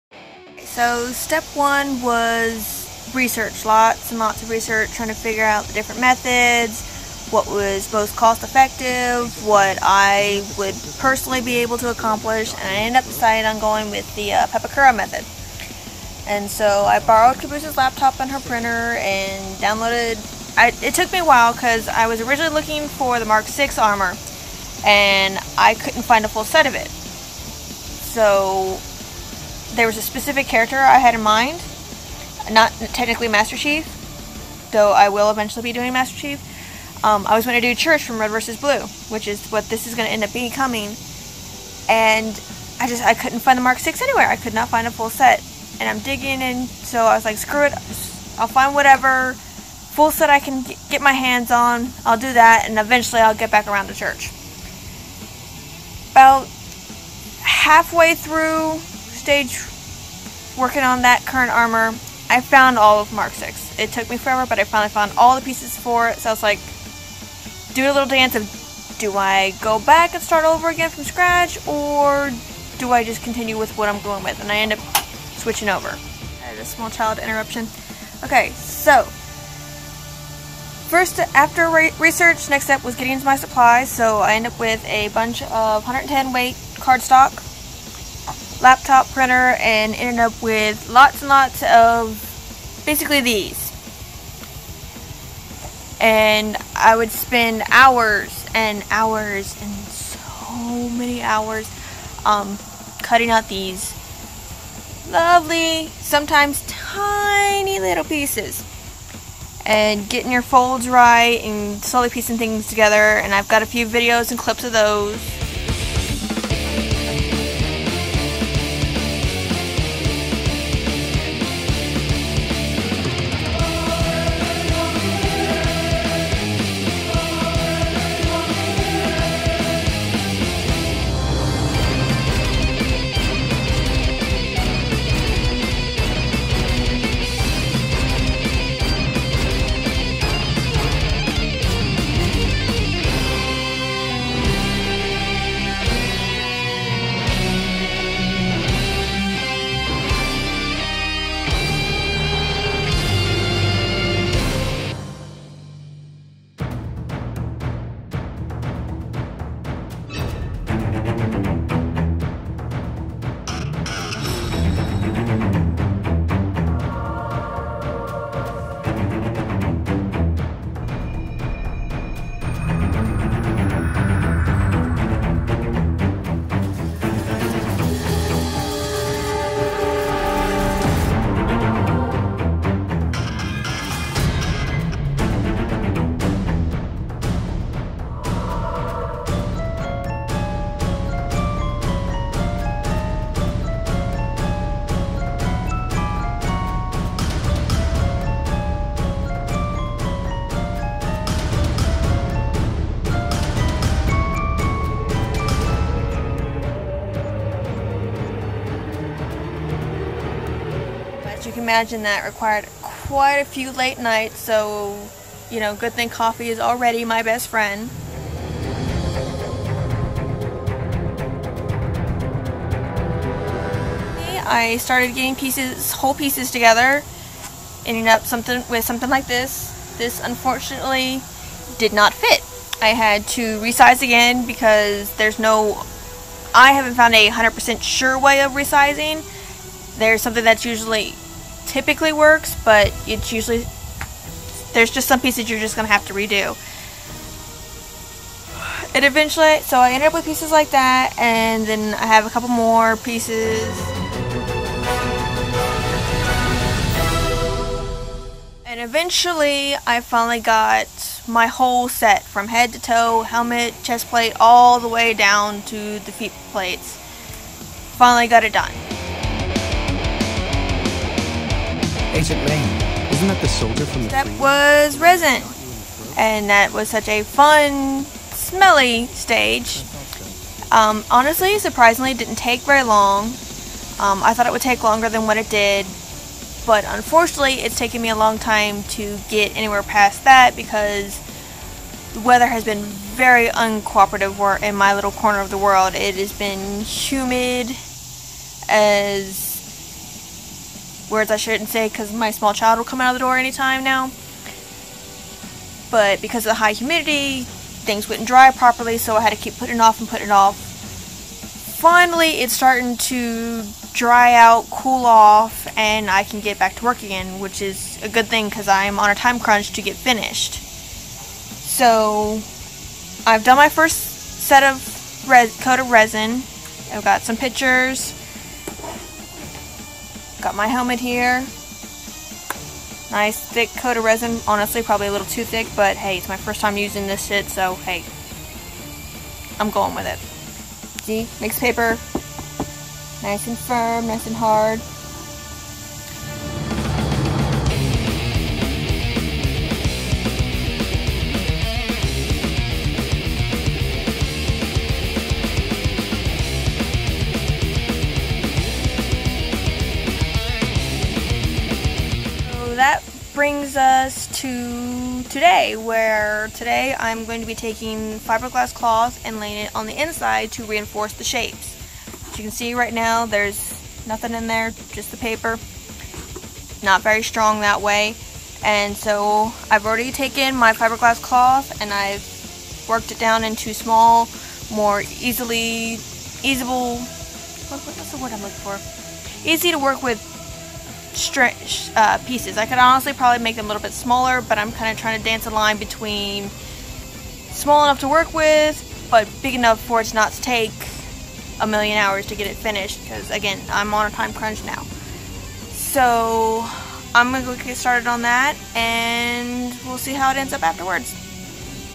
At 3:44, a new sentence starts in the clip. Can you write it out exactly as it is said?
I started getting pieces, whole pieces together, ending up something with something like this.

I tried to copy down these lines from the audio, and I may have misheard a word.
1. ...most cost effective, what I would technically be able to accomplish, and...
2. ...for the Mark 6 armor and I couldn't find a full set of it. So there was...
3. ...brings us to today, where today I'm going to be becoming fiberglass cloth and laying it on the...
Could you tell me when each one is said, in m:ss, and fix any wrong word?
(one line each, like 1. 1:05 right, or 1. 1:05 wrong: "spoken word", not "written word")
1. 0:07 wrong: "personally", not "technically"
2. 0:22 right
3. 6:03 wrong: "taking", not "becoming".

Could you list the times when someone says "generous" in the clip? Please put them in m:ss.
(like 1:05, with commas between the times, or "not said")
not said.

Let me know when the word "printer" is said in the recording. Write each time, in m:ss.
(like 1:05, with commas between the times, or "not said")
0:18, 1:29.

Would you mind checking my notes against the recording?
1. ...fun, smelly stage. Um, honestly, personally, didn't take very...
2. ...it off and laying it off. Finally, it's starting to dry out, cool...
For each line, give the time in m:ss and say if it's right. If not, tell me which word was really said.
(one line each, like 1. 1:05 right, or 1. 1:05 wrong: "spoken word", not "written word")
1. 4:37 wrong: "surprisingly", not "personally"
2. 5:09 wrong: "putting", not "laying".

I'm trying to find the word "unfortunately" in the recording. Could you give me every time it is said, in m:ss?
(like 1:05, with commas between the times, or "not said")
3:50, 4:46.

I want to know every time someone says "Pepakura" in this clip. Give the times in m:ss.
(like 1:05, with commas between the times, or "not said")
0:14.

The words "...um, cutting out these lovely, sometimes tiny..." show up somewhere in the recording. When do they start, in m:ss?
1:42.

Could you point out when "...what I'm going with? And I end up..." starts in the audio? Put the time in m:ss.
1:13.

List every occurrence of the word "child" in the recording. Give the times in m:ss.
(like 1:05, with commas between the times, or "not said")
1:16, 5:02.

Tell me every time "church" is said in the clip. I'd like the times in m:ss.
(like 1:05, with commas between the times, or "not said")
0:37, 0:53.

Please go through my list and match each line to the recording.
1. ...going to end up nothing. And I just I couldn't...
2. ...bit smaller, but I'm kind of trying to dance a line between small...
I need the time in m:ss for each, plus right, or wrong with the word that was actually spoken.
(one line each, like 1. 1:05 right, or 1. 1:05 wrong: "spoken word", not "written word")
1. 0:39 wrong: "becoming", not "nothing"
2. 6:33 right.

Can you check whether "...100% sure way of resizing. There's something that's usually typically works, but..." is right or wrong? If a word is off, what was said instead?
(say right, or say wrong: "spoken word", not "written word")
right.